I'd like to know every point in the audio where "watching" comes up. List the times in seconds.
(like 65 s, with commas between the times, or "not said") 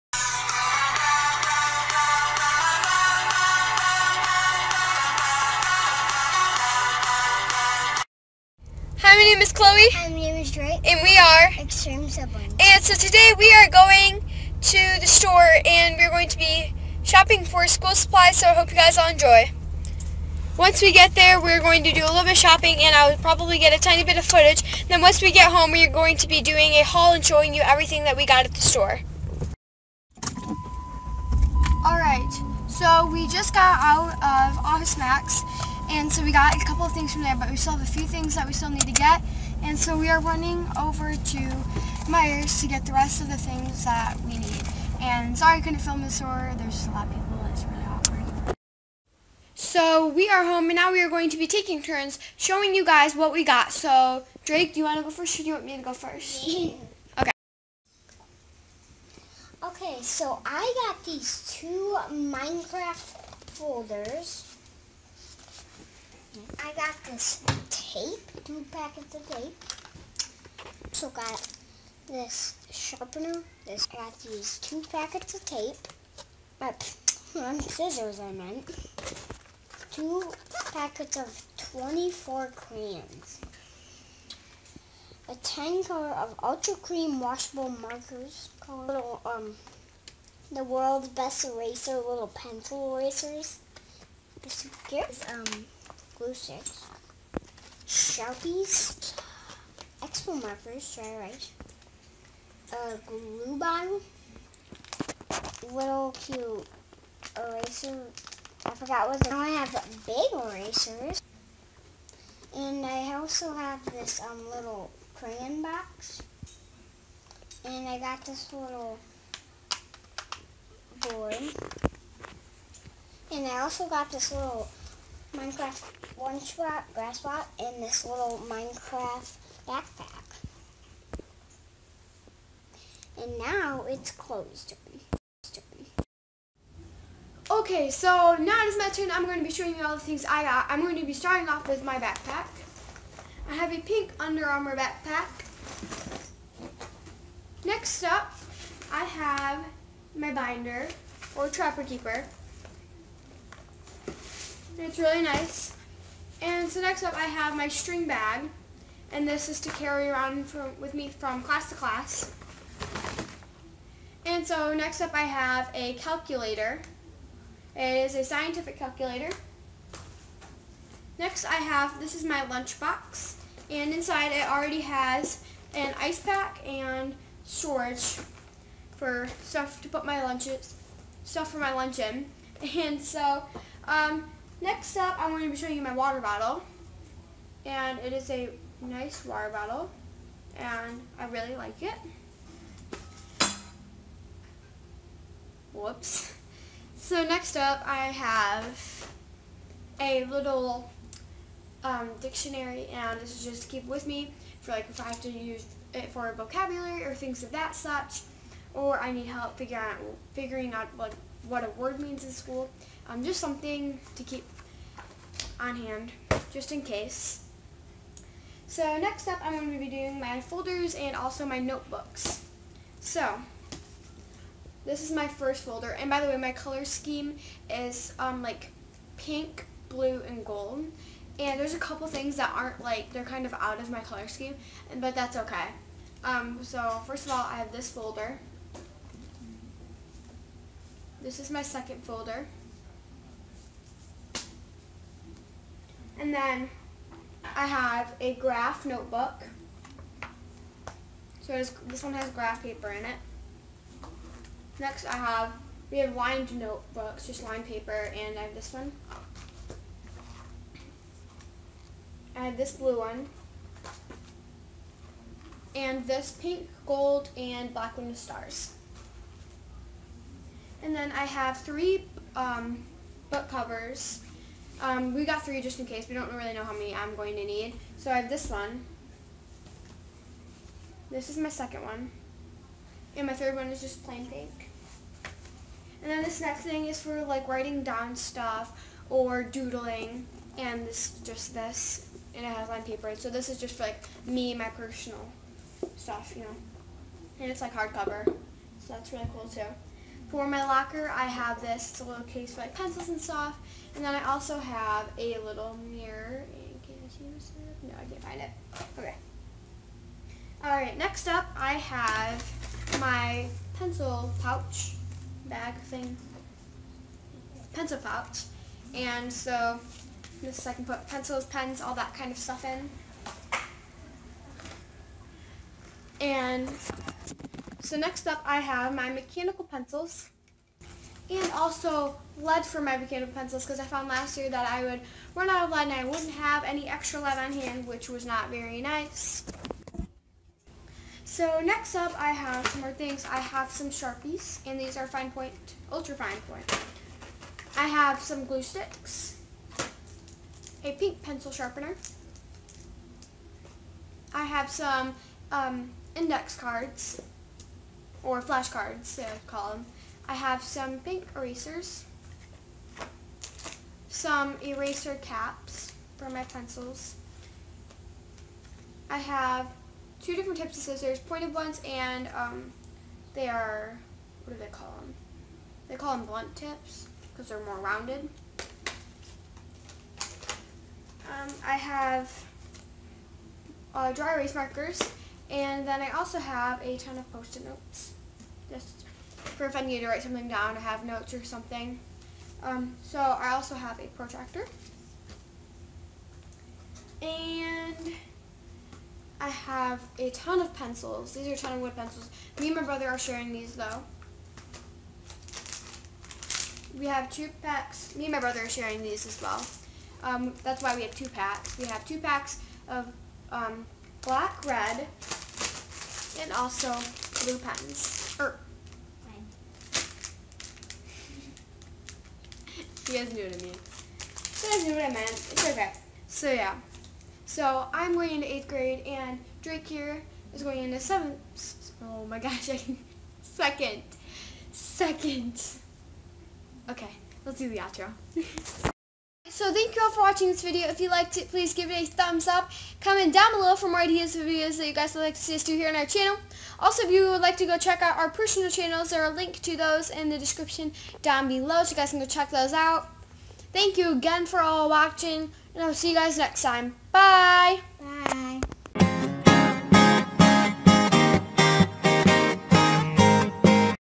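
440 s, 454 s.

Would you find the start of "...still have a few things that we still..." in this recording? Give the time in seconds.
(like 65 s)
37 s.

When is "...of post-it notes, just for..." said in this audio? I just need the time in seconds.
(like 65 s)
387 s.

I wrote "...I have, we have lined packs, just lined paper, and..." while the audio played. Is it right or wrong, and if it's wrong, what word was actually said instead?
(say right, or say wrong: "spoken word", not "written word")
wrong: "notebooks", not "packs".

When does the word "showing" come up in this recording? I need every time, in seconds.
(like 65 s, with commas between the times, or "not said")
27 s, 52 s, 139 s, 185 s.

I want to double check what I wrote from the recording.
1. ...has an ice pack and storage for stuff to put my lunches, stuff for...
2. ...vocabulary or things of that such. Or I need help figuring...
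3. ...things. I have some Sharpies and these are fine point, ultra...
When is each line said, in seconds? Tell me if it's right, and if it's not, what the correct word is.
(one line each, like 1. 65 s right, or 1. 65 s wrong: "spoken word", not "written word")
1. 174 s right
2. 206 s right
3. 342 s right.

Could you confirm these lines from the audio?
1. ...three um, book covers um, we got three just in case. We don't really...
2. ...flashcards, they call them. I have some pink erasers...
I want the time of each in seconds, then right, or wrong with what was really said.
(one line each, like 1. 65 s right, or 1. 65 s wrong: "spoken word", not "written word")
1. 271 s right
2. 358 s right.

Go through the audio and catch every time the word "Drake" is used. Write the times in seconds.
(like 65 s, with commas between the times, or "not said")
10 s, 54 s, 429 s.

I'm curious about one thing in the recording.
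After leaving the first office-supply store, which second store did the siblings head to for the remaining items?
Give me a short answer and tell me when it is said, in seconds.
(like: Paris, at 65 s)
Meijer, at 42 s.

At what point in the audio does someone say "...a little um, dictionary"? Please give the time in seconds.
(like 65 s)
199 s.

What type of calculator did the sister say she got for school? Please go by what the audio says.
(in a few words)
Scientific calculator.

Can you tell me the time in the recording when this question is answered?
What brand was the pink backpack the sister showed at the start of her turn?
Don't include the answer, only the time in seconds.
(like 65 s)
144 s.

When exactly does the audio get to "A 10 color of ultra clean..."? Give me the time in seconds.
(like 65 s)
85 s.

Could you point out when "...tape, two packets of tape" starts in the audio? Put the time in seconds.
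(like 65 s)
67 s.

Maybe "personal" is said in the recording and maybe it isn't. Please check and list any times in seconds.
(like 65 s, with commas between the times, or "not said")
294 s, 448 s.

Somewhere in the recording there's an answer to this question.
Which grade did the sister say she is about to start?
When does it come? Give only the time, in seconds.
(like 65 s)
428 s.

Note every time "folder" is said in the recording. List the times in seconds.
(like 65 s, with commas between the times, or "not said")
63 s, 220 s, 225 s, 237 s, 242 s.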